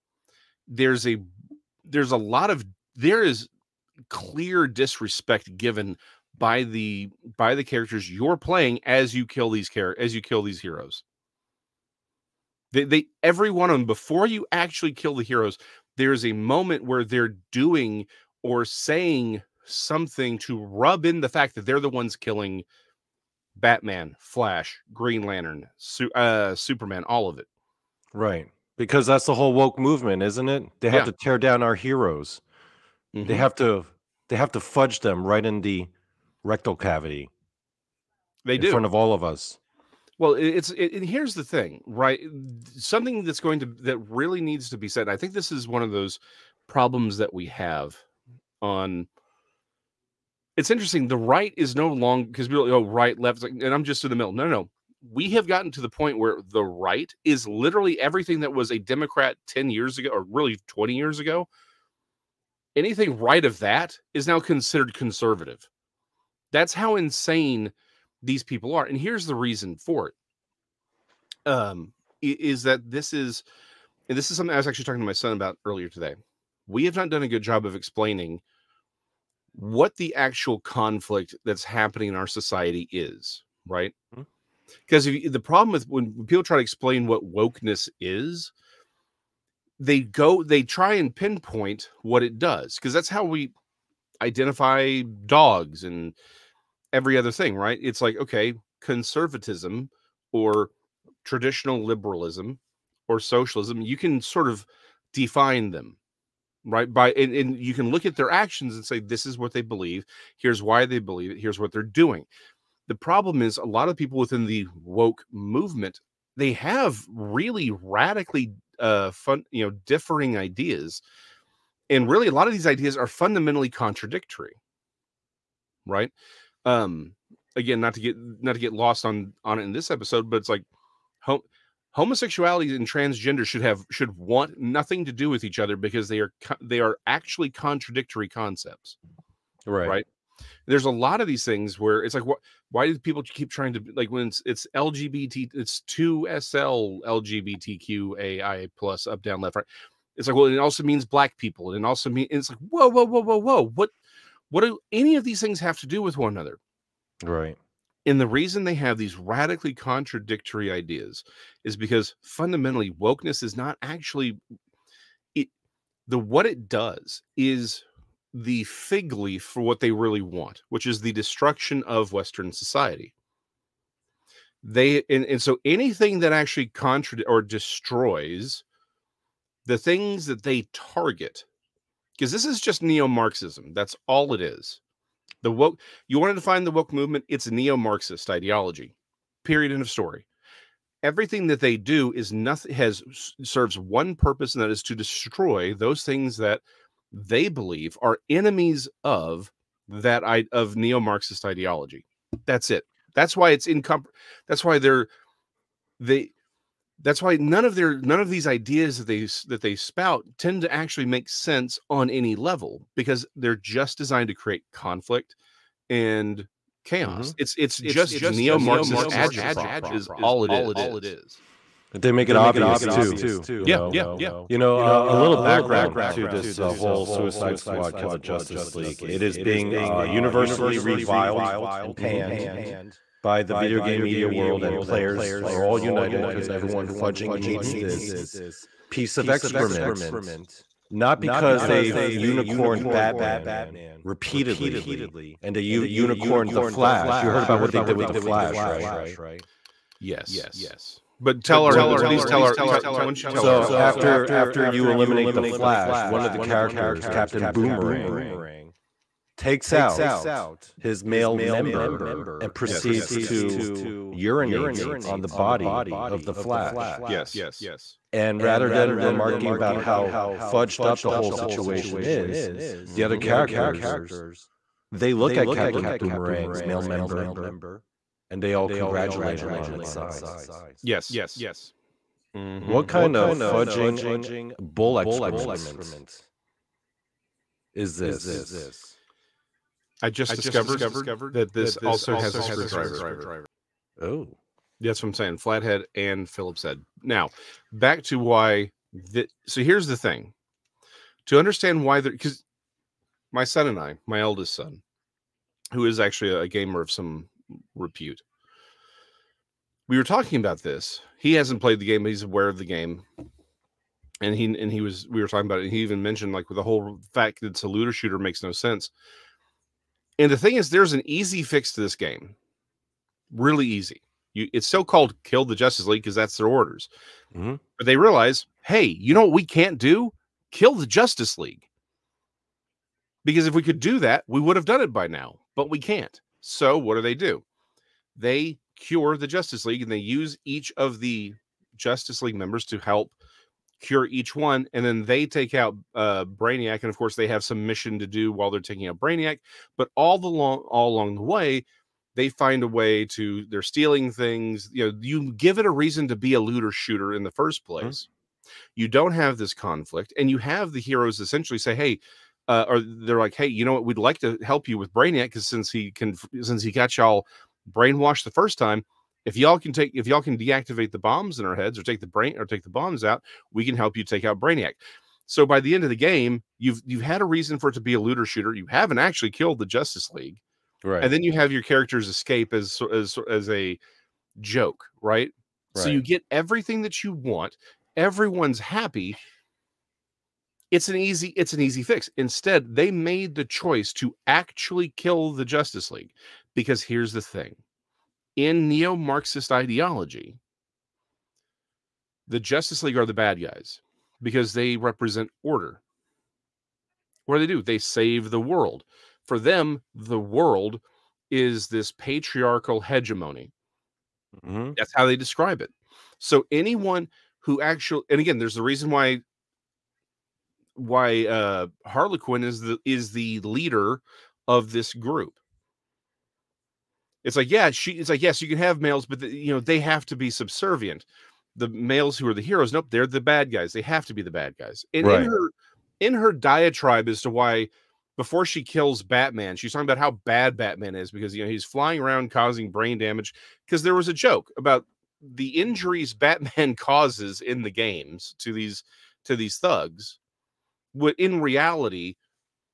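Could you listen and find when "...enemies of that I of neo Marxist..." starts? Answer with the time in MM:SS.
03:18.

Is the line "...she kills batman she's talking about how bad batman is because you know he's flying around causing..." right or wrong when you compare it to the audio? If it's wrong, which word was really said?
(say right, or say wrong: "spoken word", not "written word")
right.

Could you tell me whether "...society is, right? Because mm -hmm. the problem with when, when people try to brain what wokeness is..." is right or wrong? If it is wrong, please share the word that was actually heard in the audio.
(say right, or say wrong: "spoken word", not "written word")
wrong: "explain", not "brain".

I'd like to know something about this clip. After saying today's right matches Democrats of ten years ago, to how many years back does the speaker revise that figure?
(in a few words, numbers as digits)
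20.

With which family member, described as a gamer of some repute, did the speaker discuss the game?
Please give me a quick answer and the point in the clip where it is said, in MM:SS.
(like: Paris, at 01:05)
Eldest son, at 05:04.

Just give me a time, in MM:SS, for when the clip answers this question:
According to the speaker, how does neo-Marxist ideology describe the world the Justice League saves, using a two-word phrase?
06:51.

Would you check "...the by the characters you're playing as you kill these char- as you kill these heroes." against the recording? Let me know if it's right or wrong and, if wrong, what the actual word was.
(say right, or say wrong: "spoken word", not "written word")
right.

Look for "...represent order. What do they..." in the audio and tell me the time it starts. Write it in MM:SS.
06:44.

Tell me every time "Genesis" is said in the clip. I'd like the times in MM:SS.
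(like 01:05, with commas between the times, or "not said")
not said.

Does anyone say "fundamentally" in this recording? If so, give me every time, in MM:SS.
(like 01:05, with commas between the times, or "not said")
02:03, 02:42.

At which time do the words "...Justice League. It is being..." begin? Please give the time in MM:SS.
03:48.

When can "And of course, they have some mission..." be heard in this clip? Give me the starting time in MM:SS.
05:46.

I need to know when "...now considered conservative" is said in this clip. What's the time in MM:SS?
01:04.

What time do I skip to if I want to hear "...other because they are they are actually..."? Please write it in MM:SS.
02:15.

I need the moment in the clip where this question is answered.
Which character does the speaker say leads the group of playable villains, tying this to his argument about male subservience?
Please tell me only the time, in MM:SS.
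07:01.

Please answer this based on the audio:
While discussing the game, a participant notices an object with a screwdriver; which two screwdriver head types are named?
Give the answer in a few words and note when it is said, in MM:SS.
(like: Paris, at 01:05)
Flathead and Phillips, at 04:55.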